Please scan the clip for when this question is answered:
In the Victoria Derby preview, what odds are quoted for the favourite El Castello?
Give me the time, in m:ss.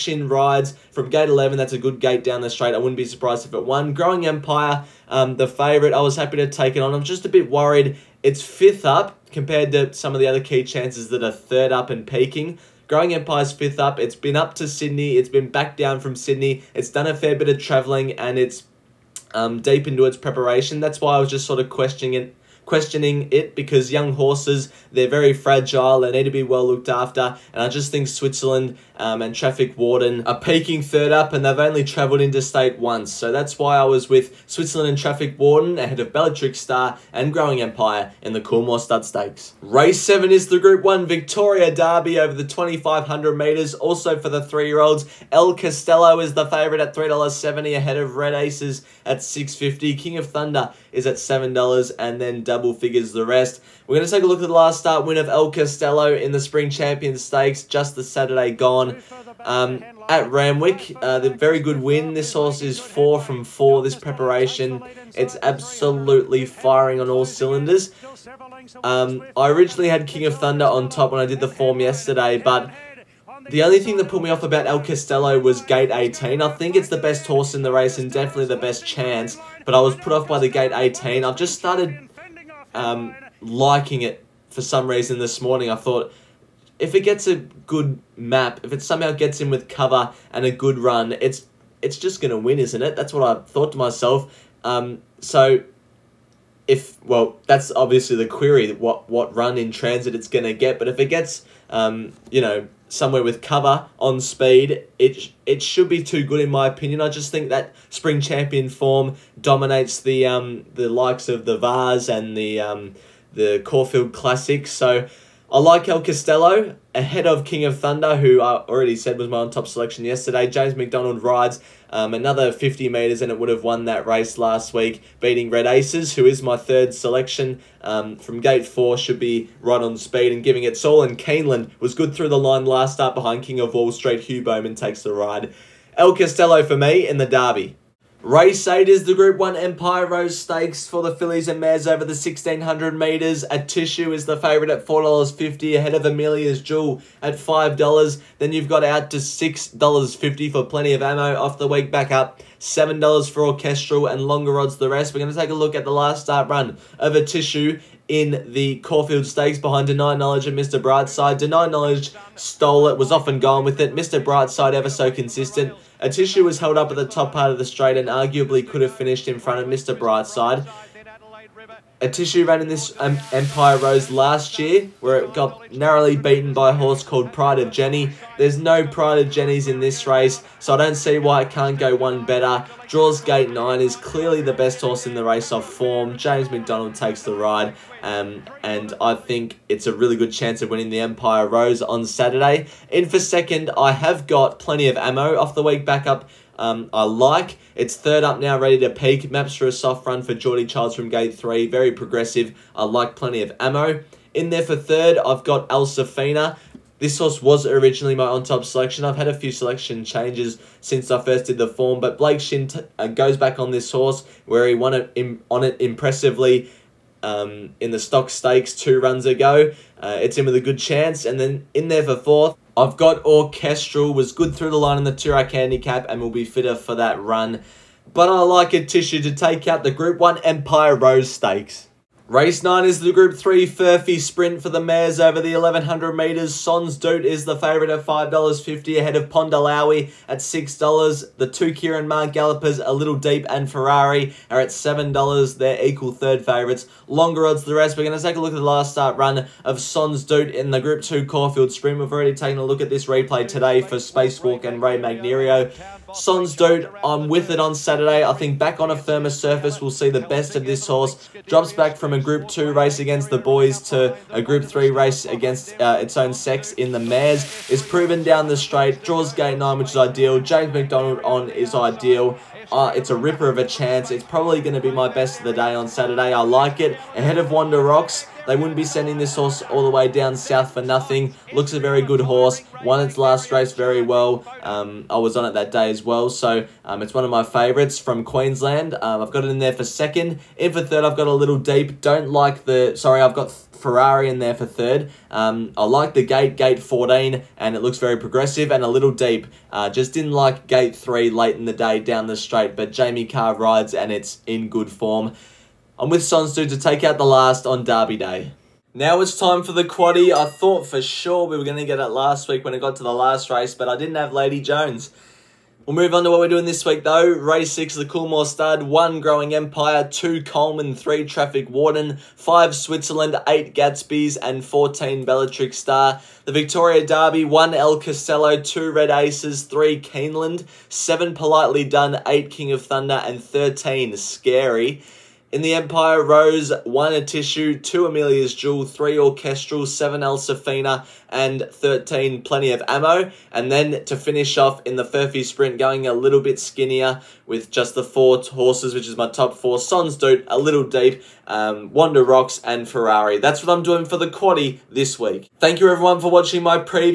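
0:46.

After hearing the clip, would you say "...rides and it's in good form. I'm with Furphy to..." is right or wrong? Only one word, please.
wrong.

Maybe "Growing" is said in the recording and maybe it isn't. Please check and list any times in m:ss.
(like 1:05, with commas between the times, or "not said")
0:03, 0:12, 0:37, 5:19.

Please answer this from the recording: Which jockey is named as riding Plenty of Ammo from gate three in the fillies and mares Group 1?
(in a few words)
Geordie Childs.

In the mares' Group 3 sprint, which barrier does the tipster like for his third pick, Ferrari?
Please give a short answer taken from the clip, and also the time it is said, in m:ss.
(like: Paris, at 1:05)
Gate 14, at 4:56.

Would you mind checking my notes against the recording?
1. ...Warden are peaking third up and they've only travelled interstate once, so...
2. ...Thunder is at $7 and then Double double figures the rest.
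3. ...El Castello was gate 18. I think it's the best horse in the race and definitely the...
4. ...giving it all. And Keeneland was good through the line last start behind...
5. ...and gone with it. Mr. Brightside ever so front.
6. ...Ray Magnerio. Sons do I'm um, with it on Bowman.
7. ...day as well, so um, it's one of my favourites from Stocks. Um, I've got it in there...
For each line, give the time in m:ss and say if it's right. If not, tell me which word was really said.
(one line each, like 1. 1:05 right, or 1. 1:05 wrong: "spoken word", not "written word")
1. 0:29 right
2. 0:50 right
3. 1:14 right
4. 2:10 right
5. 2:43 wrong: "consistent", not "front"
6. 4:14 wrong: "Saturday", not "Bowman"
7. 4:45 wrong: "Queensland", not "Stocks".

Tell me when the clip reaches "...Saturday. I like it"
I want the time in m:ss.
4:35.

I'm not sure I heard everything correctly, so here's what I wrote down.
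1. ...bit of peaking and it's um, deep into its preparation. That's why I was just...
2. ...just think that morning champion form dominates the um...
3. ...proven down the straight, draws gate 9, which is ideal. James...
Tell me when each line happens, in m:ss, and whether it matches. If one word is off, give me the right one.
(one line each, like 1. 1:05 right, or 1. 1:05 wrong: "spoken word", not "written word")
1. 0:17 wrong: "travelling", not "peaking"
2. 1:47 wrong: "spring", not "morning"
3. 4:27 right.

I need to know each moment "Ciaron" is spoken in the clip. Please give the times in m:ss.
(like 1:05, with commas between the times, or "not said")
4:01.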